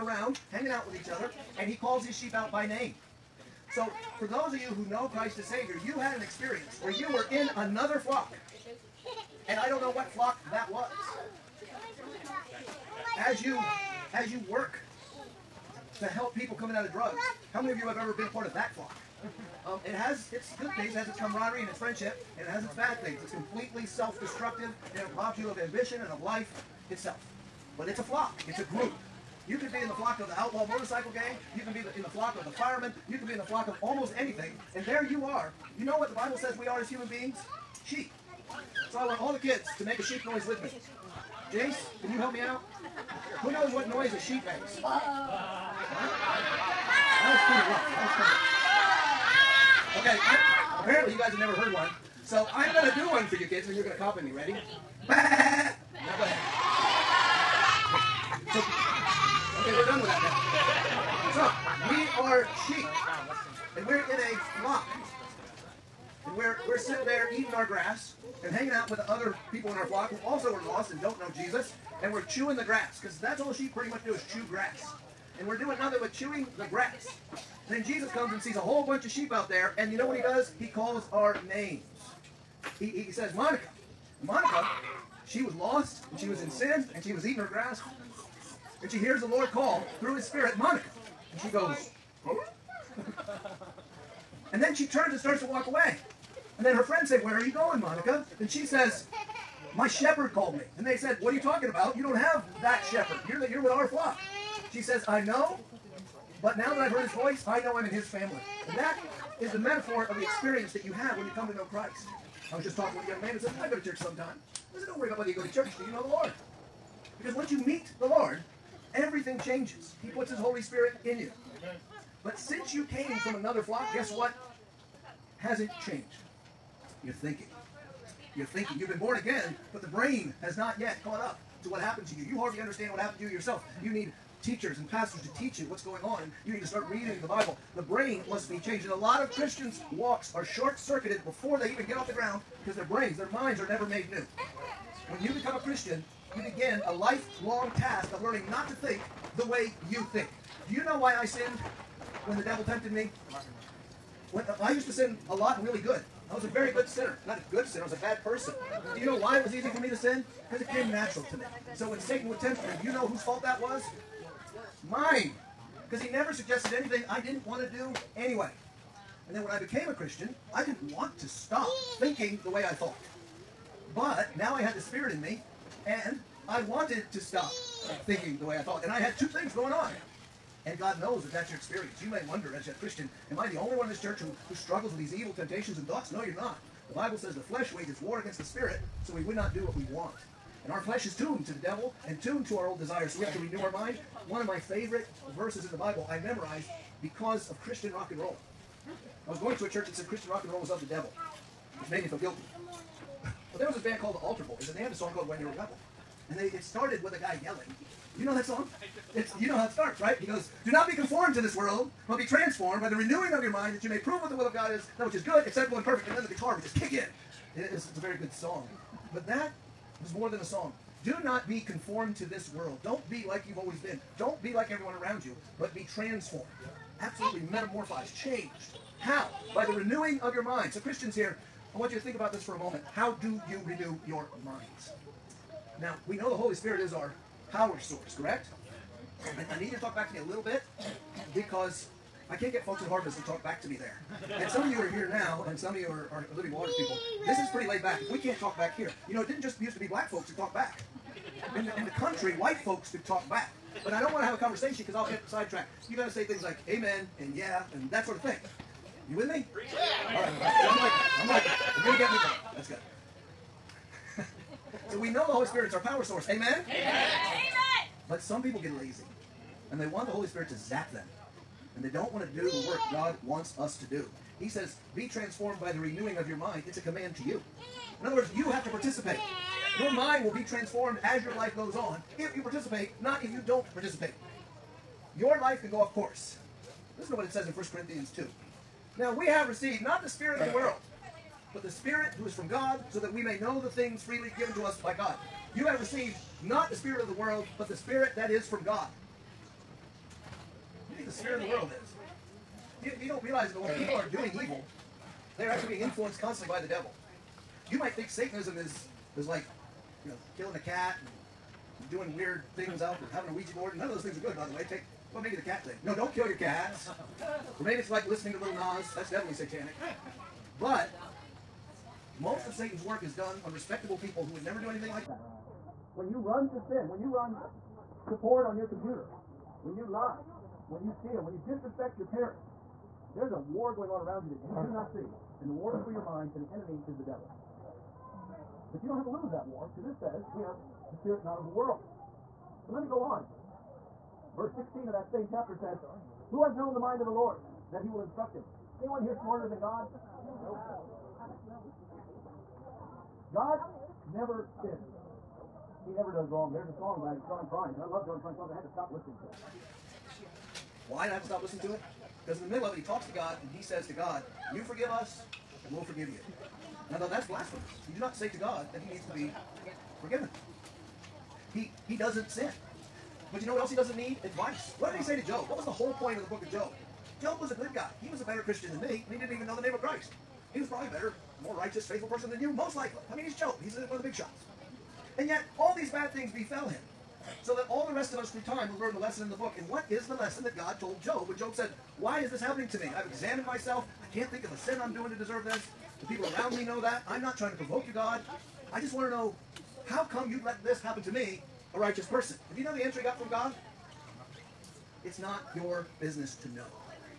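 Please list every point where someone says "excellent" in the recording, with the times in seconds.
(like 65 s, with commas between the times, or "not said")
not said.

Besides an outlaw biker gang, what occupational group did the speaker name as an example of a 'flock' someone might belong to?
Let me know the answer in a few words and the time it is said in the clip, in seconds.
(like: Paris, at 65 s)
firemen, at 32 s.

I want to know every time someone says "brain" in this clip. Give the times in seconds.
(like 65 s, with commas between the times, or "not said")
129 s, 137 s, 142 s.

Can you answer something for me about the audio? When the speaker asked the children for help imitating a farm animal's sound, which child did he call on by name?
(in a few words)
Jace.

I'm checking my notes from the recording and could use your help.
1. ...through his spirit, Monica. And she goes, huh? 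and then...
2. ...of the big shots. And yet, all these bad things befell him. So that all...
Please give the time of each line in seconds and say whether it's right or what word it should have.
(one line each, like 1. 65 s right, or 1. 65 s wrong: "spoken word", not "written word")
1. 89 s right
2. 383 s right.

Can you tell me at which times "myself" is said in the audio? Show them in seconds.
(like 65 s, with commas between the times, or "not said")
393 s.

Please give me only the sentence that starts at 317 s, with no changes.
or maybe it's like listening to Little Nas.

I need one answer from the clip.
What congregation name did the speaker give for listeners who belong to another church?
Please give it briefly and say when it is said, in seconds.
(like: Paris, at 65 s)
Living Waters, at 246 s.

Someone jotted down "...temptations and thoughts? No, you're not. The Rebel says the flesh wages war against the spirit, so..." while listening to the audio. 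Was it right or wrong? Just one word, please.
wrong.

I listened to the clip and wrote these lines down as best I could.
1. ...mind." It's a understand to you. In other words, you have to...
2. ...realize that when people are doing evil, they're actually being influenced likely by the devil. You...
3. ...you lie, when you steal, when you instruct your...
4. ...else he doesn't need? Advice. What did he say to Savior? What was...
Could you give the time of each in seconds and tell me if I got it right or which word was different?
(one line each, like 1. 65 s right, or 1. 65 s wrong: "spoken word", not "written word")
1. 276 s wrong: "command", not "understand"
2. 303 s wrong: "constantly", not "likely"
3. 329 s wrong: "disrespect", not "instruct"
4. 373 s wrong: "Job", not "Savior".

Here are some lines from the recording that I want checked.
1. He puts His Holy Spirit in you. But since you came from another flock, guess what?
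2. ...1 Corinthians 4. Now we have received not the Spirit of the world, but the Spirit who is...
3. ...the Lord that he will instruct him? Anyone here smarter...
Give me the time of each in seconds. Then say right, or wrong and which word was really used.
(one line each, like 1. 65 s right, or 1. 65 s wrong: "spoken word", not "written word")
1. 120 s right
2. 287 s wrong: "2", not "4"
3. 347 s right.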